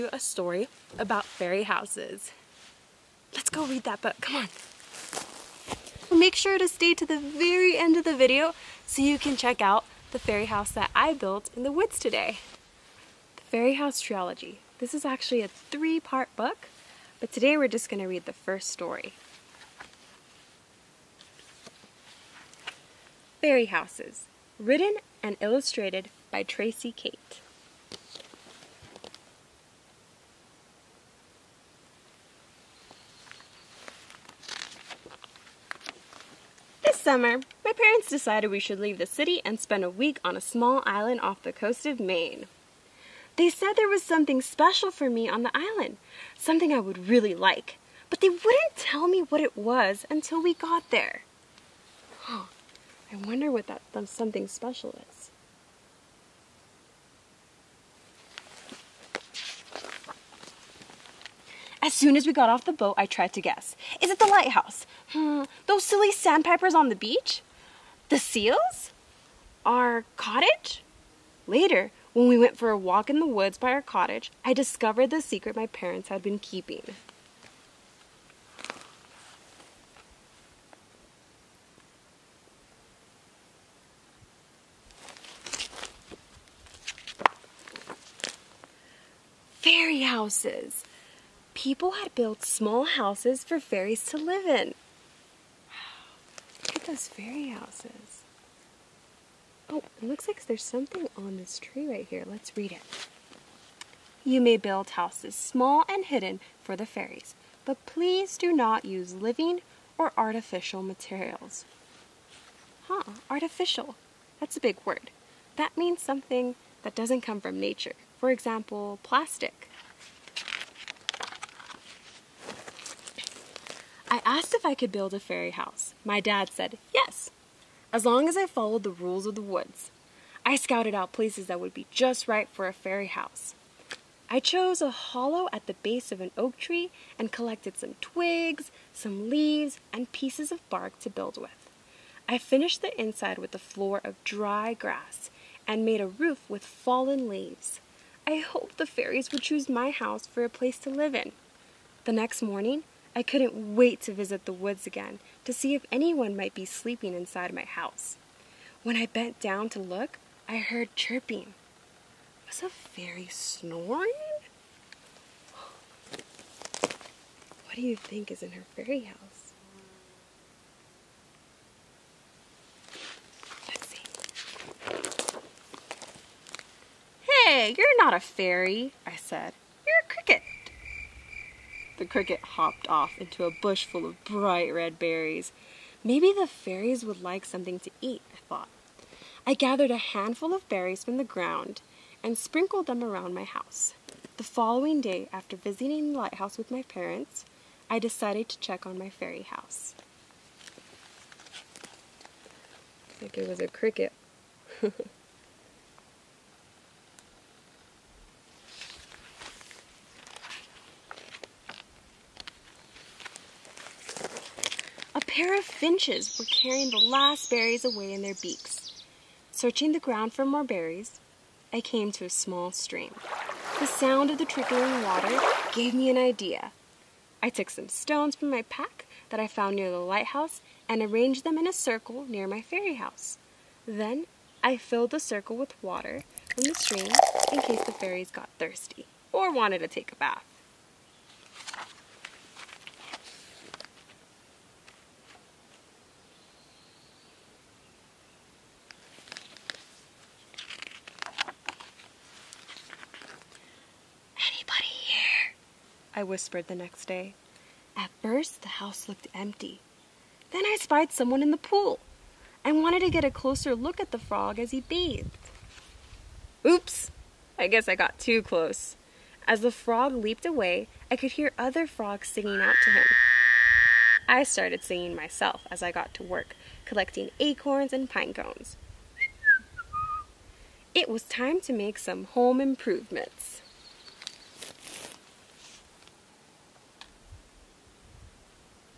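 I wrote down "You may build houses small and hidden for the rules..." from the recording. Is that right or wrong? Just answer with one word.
wrong.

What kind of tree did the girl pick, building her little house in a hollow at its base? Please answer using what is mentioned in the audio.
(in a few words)
Oak.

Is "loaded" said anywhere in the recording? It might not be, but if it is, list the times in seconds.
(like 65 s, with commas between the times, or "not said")
not said.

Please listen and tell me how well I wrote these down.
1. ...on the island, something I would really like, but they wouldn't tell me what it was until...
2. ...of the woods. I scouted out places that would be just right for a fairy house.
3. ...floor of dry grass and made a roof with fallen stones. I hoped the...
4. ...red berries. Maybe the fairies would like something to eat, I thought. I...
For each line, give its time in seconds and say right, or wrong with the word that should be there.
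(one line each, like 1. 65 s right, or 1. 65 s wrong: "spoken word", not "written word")
1. 45 s right
2. 129 s right
3. 143 s wrong: "leaves", not "stones"
4. 184 s right.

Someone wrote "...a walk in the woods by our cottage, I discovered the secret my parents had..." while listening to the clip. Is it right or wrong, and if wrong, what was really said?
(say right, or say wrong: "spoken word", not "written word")
right.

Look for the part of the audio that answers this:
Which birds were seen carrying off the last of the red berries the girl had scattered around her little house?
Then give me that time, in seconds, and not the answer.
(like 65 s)
215 s.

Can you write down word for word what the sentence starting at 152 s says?
The next morning, I couldn't wait to visit the woods again to see if anyone might be sleeping inside my house.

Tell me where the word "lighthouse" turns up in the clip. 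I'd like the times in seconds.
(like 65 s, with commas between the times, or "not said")
64 s, 196 s, 229 s.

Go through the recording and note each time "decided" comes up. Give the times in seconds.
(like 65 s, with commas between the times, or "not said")
38 s, 197 s.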